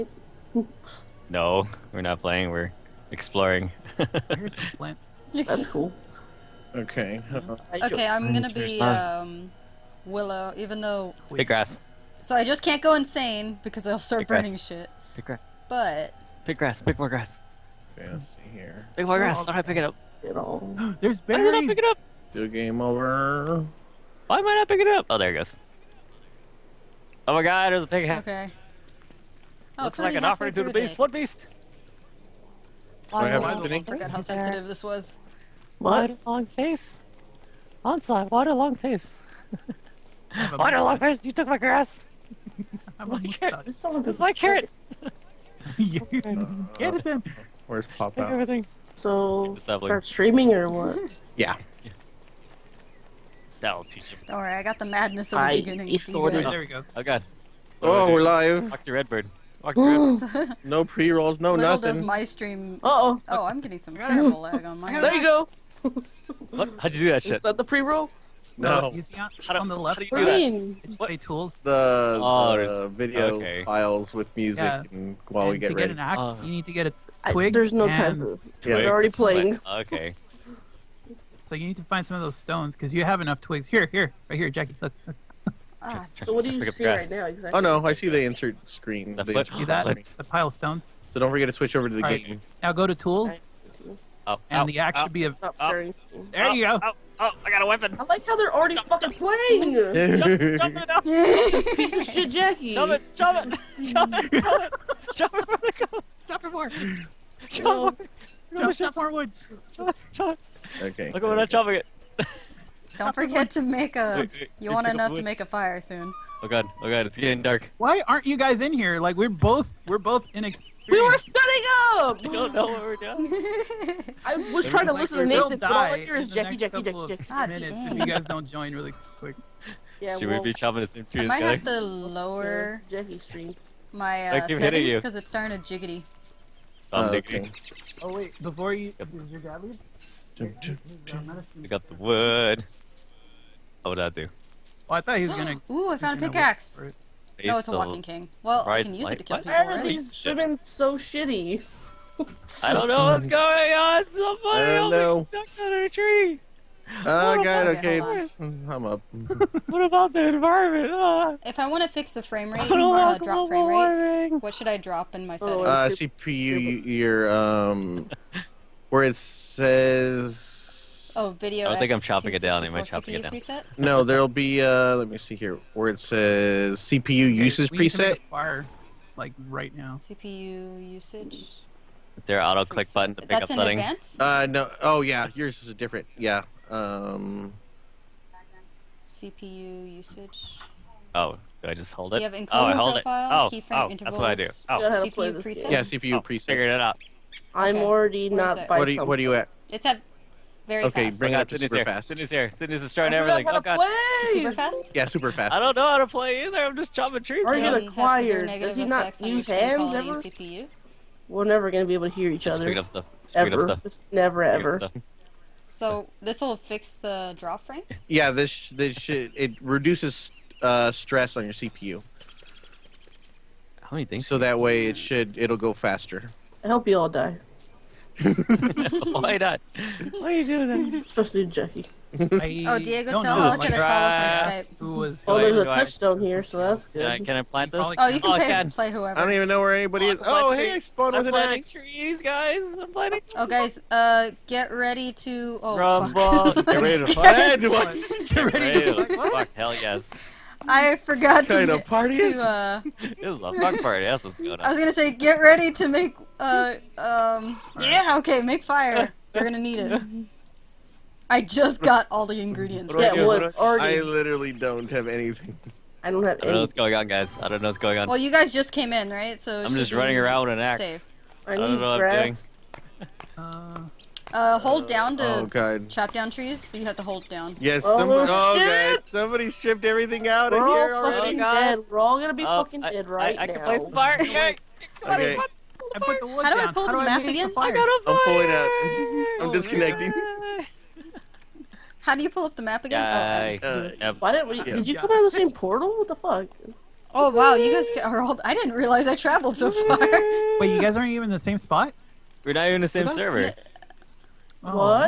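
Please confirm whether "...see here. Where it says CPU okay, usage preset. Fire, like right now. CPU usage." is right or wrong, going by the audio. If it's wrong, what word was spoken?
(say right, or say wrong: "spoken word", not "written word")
right.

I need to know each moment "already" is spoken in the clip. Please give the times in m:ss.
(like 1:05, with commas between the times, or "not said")
1:18, 1:38, 3:17, 4:23, 4:40.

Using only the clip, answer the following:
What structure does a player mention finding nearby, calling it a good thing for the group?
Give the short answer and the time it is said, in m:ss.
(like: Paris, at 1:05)
touchstone, at 3:55.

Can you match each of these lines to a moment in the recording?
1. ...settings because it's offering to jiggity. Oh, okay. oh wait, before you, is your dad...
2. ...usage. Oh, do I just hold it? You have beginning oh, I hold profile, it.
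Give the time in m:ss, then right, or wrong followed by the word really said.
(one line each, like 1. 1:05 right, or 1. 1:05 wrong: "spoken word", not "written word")
1. 2:14 wrong: "starting", not "offering"
2. 3:09 wrong: "encoding", not "beginning".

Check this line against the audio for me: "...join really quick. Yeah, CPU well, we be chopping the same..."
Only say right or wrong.
wrong.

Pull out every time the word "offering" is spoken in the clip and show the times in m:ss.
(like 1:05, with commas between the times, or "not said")
0:30.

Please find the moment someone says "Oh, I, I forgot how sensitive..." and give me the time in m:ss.
0:33.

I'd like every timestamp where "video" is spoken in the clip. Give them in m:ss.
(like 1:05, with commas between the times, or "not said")
1:12, 2:51.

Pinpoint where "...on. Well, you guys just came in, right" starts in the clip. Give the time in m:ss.
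4:27.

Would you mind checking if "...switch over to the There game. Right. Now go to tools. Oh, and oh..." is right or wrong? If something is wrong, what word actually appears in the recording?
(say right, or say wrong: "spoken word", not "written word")
wrong: "All", not "There".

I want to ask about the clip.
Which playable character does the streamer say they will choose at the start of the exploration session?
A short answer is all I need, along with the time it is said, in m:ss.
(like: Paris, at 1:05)
Willow, at 0:10.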